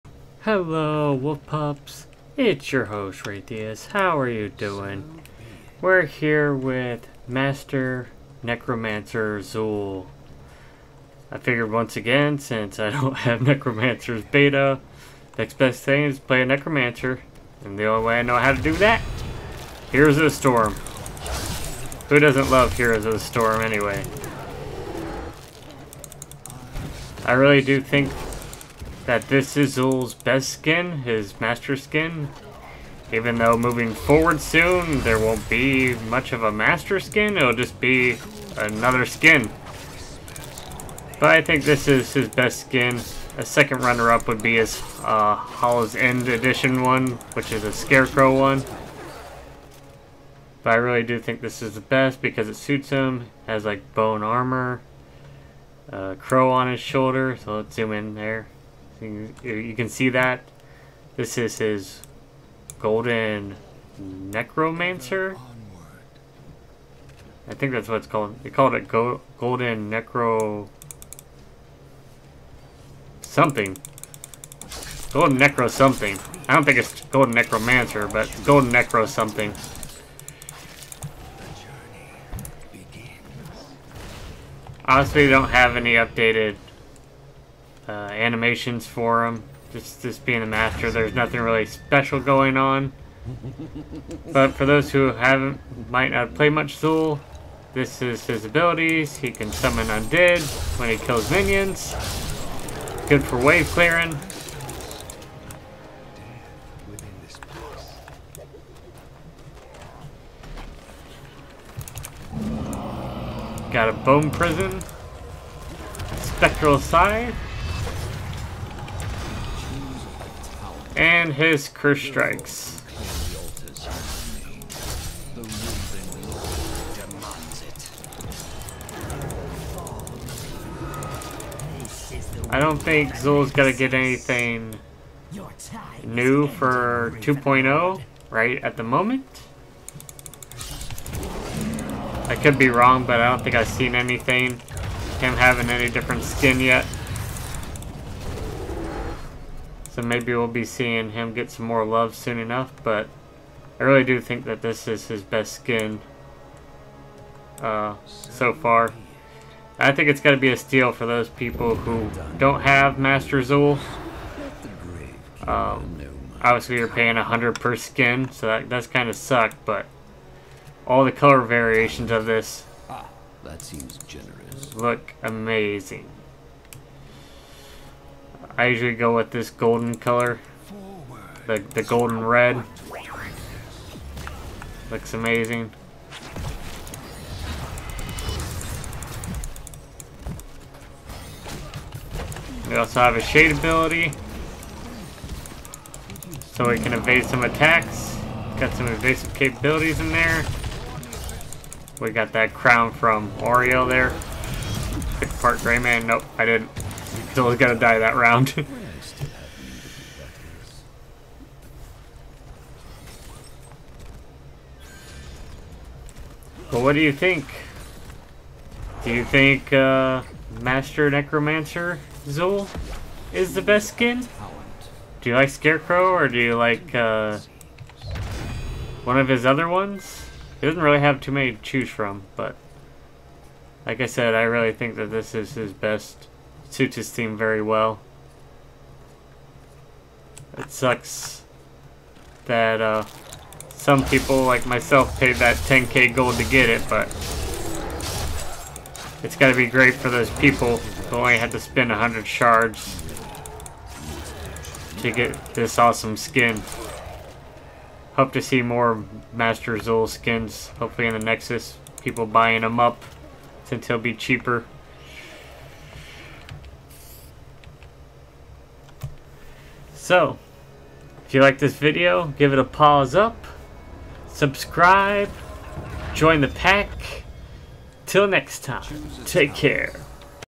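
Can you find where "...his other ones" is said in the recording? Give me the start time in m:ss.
3:49.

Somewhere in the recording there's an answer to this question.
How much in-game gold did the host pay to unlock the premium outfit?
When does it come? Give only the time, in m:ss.
4:05.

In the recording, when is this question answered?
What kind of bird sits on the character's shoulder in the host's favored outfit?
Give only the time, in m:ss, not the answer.
0:56.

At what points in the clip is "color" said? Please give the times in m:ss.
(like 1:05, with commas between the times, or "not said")
2:51, 2:59.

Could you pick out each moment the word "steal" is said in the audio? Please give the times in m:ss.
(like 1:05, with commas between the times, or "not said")
2:40.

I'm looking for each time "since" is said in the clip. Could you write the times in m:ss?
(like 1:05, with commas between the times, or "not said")
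0:12, 4:23.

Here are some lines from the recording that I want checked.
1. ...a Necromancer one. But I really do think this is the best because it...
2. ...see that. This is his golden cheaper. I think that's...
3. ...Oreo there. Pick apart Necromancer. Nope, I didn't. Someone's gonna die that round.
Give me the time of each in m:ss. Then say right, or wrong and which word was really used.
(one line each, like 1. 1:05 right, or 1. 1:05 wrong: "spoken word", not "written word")
1. 0:47 wrong: "Scarecrow", not "Necromancer"
2. 0:59 wrong: "necromancer", not "cheaper"
3. 3:23 wrong: "Greymane", not "Necromancer".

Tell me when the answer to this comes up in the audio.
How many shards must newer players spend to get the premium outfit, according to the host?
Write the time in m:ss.
4:11.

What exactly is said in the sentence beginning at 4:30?
So, if you like this video, give it a paws up, subscribe, join the pack.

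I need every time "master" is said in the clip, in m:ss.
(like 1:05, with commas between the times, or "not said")
0:07, 0:31, 0:36, 1:30, 2:42, 3:40, 4:19.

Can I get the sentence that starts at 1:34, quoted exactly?
But for those who haven't, might not play much Xul.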